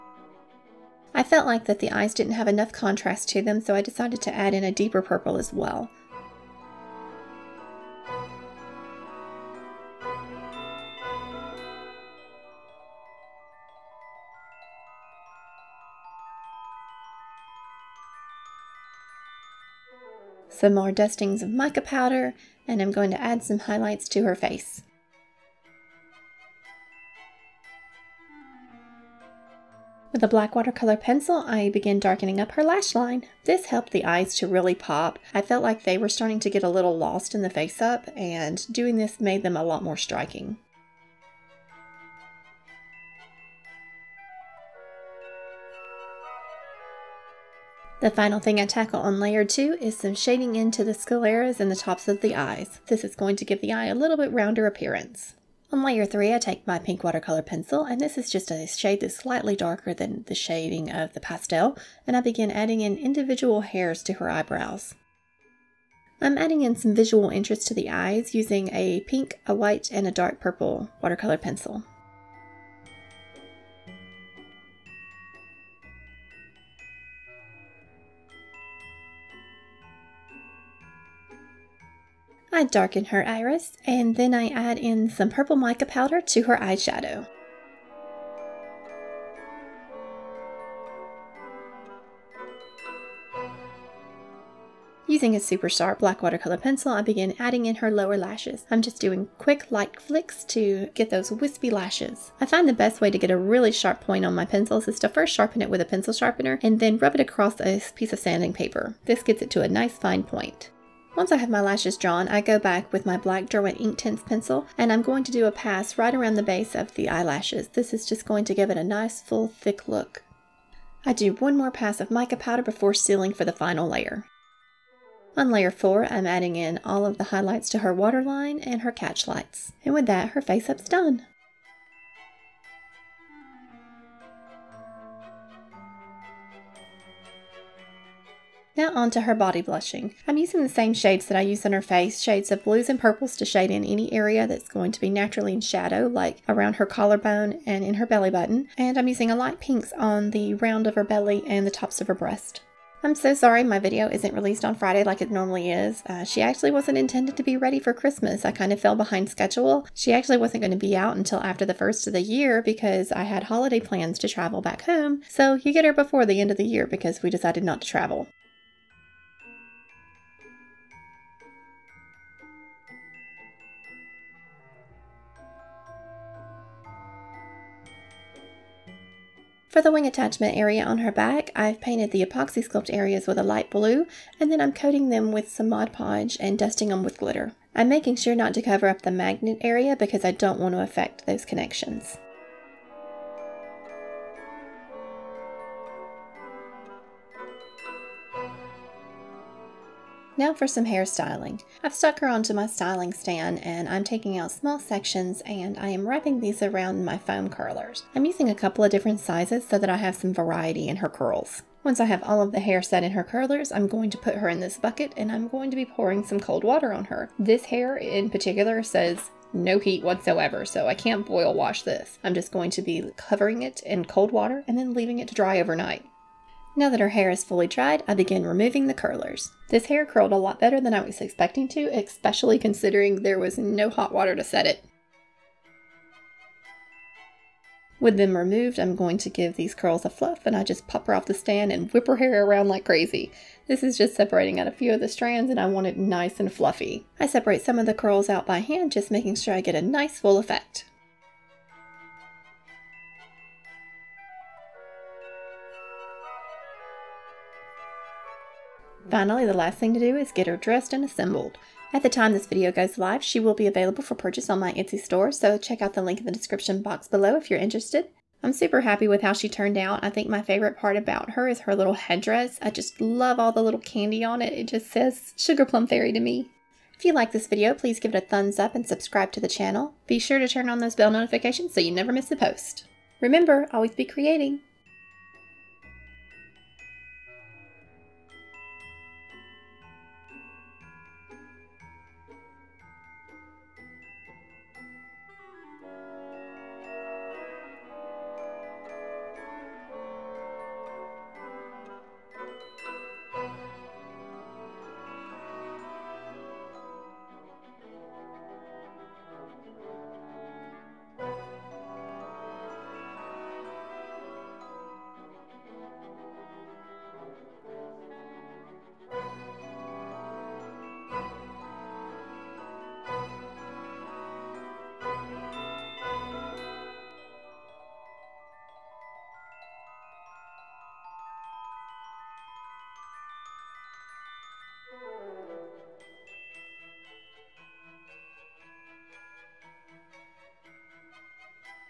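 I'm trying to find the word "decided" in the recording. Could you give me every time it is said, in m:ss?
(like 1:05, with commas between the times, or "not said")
0:03, 2:47.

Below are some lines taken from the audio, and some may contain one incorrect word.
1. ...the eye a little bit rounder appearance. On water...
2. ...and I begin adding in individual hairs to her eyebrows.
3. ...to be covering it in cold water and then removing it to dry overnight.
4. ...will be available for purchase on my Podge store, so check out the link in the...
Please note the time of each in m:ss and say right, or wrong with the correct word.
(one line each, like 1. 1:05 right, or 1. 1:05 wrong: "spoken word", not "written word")
1. 0:53 wrong: "layer", not "water"
2. 1:02 right
3. 3:42 wrong: "leaving", not "removing"
4. 4:23 wrong: "Etsy", not "Podge".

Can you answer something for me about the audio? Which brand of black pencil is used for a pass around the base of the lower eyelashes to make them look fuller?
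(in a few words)
Derwent Inktense.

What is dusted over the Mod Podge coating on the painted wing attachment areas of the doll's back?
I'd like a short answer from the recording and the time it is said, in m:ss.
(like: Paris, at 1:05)
Glitter, at 3:07.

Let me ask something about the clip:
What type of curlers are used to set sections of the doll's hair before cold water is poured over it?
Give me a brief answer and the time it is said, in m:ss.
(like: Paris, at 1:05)
Foam curlers, at 3:27.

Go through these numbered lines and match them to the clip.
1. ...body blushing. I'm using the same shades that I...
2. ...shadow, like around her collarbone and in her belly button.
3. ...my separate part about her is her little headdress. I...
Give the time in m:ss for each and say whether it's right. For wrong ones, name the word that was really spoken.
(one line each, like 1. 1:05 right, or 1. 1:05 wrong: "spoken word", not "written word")
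1. 2:19 right
2. 2:25 right
3. 4:30 wrong: "favorite", not "separate".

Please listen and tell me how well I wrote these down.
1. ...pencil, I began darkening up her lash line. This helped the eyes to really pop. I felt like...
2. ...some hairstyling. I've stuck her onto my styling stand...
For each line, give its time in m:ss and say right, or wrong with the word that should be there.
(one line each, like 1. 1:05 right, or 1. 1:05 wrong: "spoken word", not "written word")
1. 0:30 right
2. 3:20 right.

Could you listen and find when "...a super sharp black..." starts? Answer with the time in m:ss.
1:35.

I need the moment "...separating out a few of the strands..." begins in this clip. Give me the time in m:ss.
4:04.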